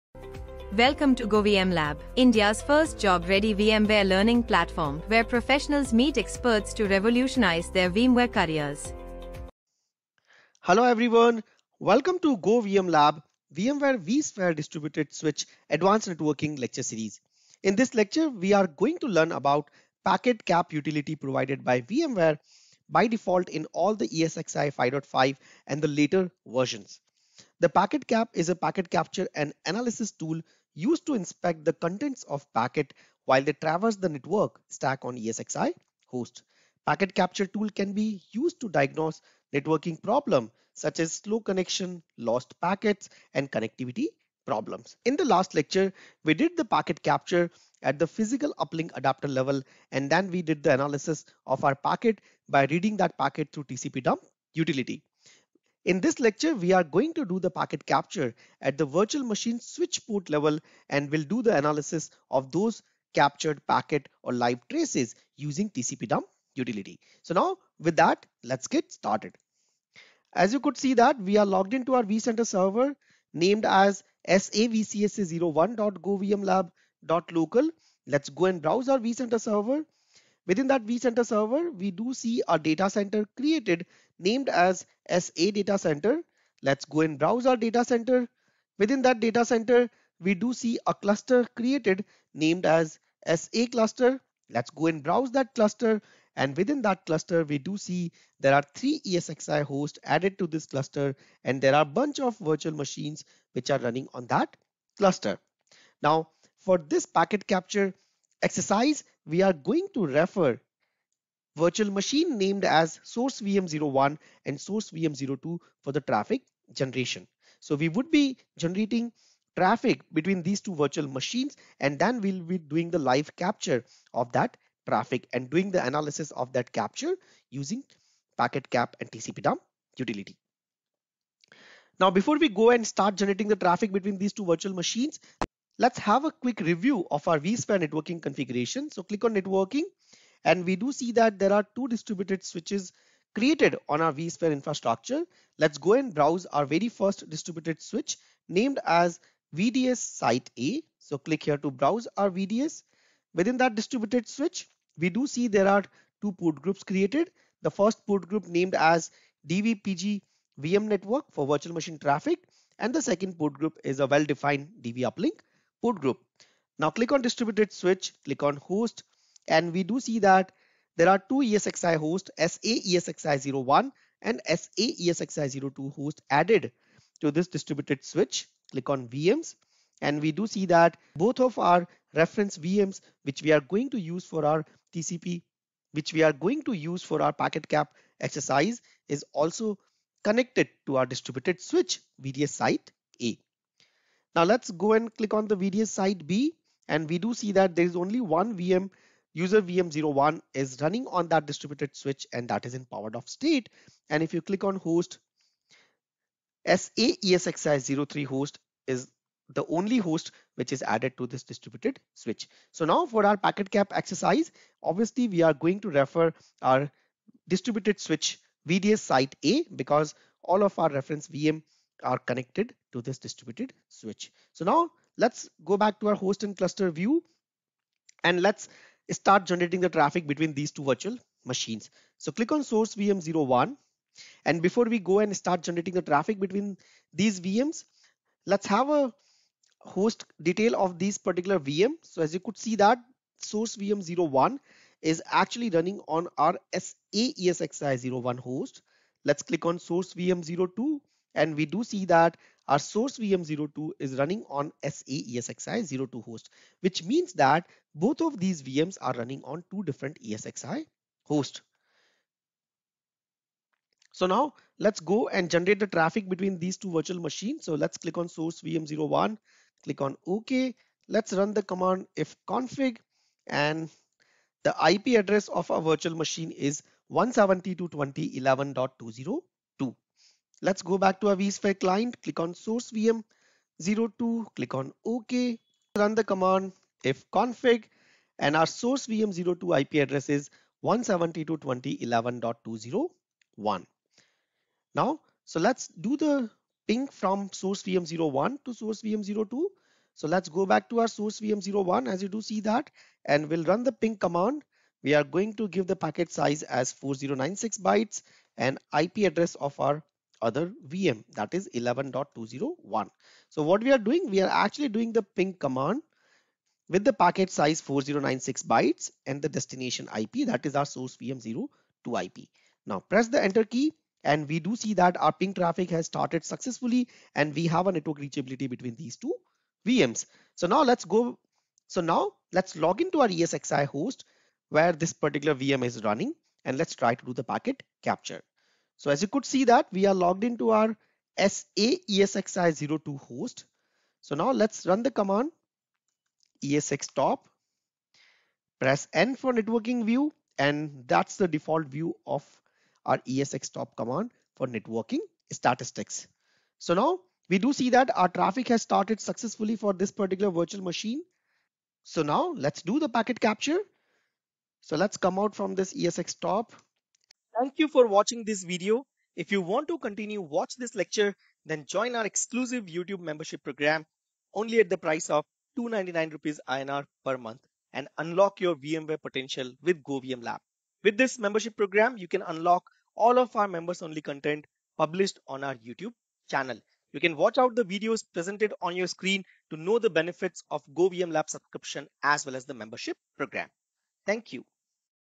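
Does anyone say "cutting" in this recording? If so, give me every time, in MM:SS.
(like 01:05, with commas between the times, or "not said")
not said.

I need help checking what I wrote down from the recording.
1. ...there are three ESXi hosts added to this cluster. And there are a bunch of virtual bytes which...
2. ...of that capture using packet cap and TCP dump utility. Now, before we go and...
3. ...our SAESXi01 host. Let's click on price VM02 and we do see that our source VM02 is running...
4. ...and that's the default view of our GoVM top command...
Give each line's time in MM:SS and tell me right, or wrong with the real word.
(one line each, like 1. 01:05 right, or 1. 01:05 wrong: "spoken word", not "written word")
1. 01:38 wrong: "machines", not "bytes"
2. 02:06 right
3. 04:06 wrong: "source", not "price"
4. 05:50 wrong: "ESX", not "GoVM".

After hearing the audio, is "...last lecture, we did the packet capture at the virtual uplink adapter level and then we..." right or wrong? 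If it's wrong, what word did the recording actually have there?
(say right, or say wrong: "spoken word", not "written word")
wrong: "physical", not "virtual".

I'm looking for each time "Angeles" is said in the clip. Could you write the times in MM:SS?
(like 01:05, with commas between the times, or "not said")
not said.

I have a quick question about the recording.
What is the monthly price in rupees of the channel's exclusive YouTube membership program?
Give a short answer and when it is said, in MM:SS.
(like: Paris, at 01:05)
299, at 06:15.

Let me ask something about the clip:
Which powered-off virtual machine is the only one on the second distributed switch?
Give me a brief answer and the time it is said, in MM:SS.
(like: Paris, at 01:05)
user VM01, at 03:19.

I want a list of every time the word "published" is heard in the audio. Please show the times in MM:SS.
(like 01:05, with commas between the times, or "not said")
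06:24.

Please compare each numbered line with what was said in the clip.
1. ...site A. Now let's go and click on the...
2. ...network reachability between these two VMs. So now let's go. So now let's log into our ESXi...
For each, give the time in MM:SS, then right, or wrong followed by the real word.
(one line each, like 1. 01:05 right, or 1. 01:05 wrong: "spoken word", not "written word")
1. 03:12 right
2. 05:27 right.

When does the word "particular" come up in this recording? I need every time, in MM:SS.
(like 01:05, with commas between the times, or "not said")
04:01, 05:35, 06:00.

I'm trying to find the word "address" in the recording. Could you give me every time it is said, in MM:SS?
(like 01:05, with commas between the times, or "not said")
04:35, 04:49, 05:09.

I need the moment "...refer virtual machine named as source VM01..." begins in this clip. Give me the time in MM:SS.
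01:50.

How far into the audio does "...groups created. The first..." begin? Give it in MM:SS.
02:36.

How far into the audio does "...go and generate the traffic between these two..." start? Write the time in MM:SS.
04:24.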